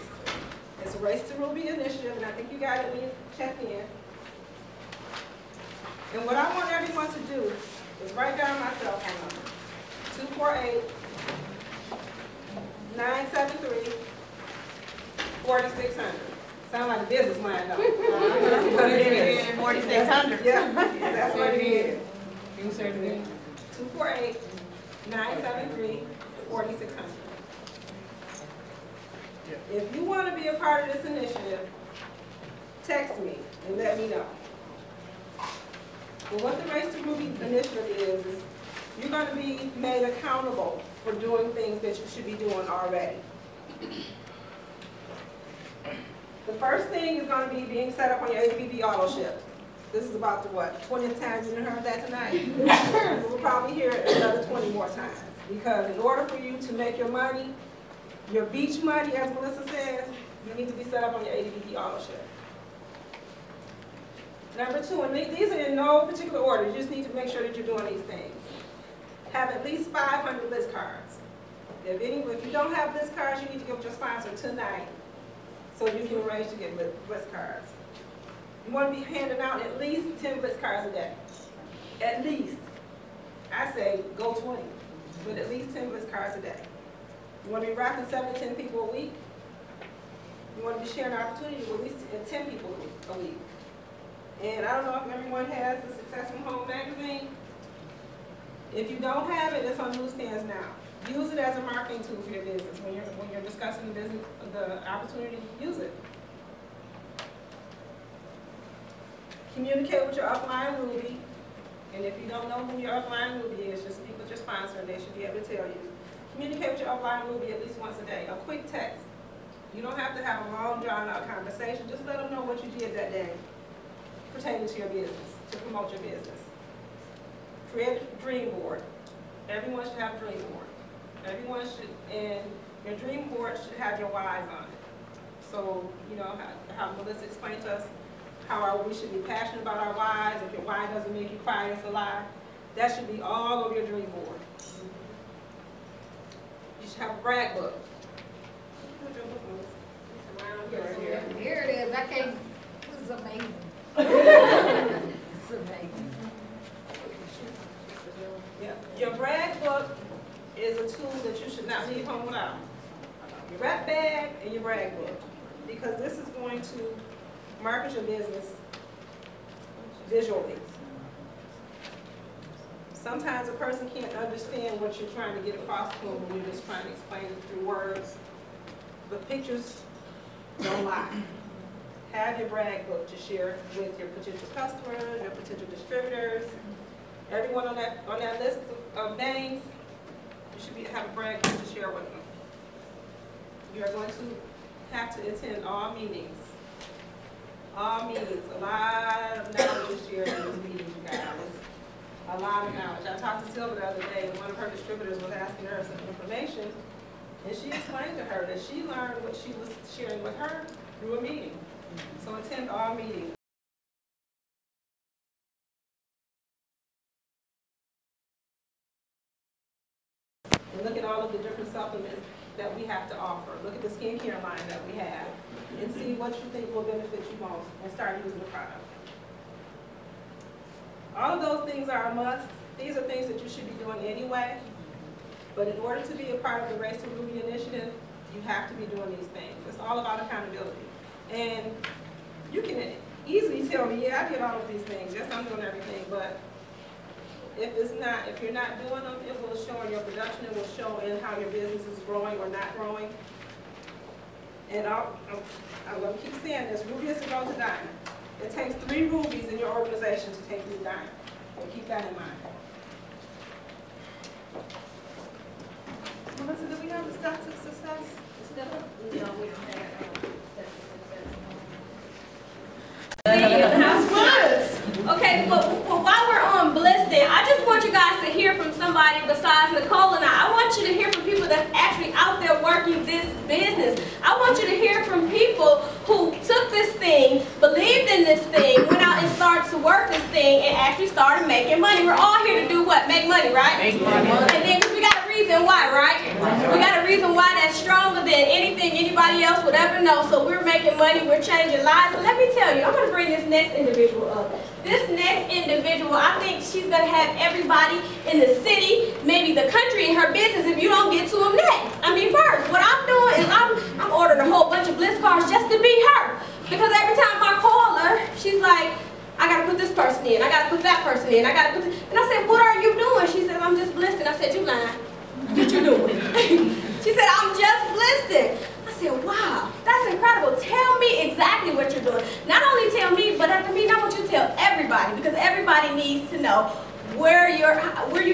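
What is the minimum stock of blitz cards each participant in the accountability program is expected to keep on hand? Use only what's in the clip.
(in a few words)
500.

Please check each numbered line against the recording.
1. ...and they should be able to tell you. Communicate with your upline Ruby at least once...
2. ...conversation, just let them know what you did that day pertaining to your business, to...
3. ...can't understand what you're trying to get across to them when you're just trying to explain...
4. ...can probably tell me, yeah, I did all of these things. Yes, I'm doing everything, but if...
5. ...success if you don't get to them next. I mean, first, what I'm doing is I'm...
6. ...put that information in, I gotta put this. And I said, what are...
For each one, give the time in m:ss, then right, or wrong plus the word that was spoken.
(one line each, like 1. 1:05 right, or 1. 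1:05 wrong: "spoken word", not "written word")
1. 1:54 right
2. 2:01 right
3. 2:53 right
4. 4:02 wrong: "easily", not "probably"
5. 5:10 wrong: "business", not "success"
6. 5:20 wrong: "person", not "information".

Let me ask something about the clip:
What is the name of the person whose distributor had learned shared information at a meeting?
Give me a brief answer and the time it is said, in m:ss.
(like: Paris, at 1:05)
Sylvia, at 3:23.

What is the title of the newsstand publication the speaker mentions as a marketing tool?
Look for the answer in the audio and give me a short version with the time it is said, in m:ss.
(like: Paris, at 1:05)
Successful Home magazine, at 1:35.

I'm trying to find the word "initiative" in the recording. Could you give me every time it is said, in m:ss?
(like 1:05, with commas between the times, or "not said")
0:01, 0:31, 0:37, 3:57.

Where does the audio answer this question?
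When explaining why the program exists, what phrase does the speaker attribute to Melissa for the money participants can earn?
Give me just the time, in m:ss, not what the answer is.
0:58.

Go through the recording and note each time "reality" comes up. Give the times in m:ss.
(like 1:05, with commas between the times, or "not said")
not said.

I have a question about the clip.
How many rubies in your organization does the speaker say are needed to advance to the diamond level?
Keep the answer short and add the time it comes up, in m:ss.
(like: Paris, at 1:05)
3, at 4:18.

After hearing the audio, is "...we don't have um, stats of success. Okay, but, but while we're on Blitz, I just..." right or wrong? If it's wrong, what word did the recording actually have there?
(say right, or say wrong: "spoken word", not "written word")
wrong: "Blessed", not "Blitz".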